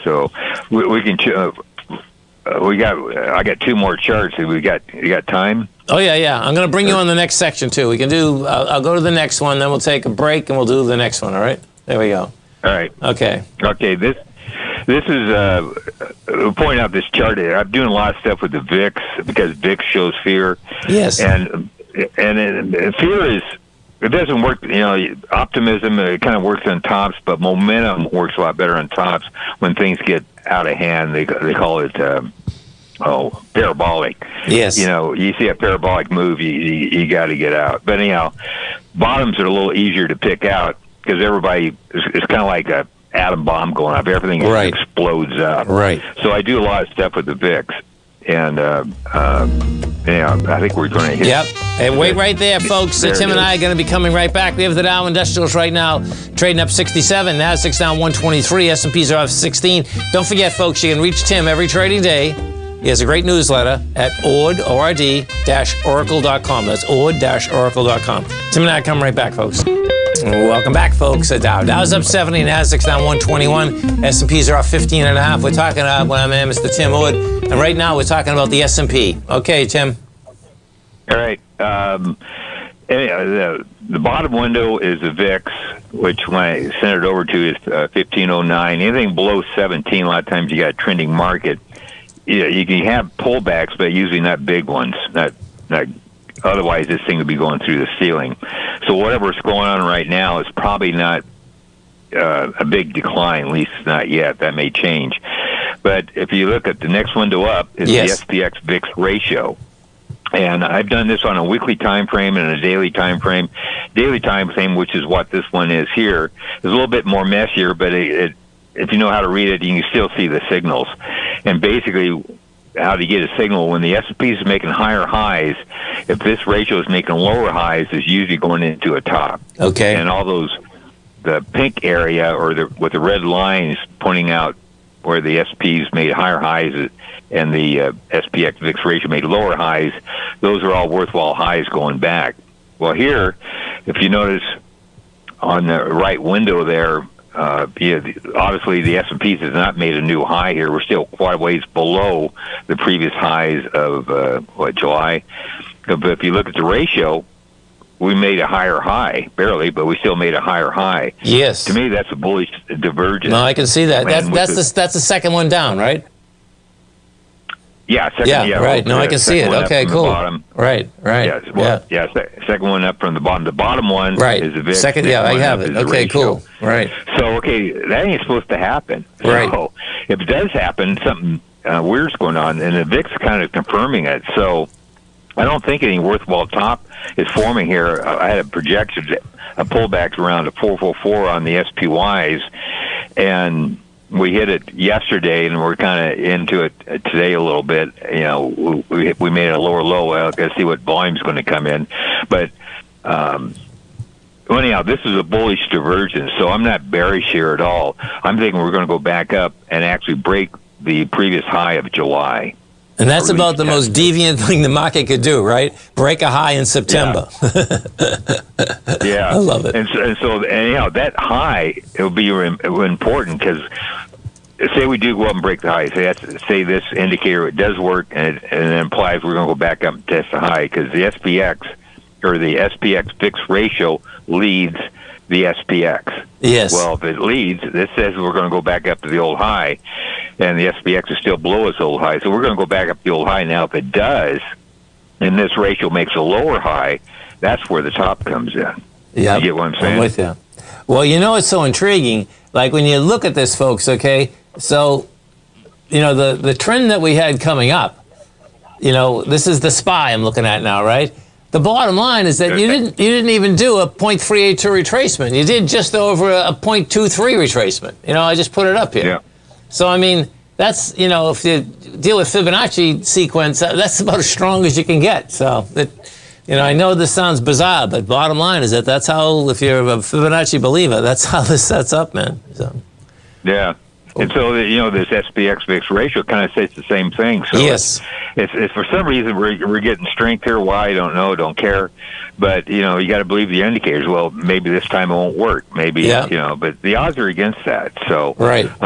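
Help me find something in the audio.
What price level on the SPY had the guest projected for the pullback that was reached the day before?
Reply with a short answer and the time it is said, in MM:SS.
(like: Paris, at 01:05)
444, at 03:10.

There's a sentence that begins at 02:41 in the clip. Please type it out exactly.
To me, that's a bullish divergence.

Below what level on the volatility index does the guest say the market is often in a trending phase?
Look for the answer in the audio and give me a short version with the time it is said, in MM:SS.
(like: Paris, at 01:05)
17, at 01:29.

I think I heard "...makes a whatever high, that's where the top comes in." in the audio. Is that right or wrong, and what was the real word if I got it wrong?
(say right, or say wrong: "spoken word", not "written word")
wrong: "lower", not "whatever".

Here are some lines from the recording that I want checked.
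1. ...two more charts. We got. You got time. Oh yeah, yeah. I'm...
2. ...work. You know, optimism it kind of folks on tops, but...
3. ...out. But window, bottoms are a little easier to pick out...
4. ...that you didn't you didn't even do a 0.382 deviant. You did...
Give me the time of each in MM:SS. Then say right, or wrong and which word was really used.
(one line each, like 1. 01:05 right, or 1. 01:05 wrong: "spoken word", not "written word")
1. 00:03 right
2. 00:24 wrong: "works", not "folks"
3. 00:37 wrong: "anyhow", not "window"
4. 04:22 wrong: "retracement", not "deviant".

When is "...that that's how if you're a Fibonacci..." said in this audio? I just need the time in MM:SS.
04:38.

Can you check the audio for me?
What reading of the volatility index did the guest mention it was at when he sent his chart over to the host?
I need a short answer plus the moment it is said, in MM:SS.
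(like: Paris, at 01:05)
15.09, at 01:27.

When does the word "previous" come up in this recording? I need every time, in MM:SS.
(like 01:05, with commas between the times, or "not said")
02:32, 03:31.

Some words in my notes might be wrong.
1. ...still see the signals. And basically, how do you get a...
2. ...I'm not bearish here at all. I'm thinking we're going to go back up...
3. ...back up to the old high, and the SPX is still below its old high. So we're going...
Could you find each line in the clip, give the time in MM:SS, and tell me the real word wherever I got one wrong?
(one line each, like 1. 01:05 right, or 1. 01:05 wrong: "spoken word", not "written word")
1. 01:59 right
2. 03:26 right
3. 03:58 right.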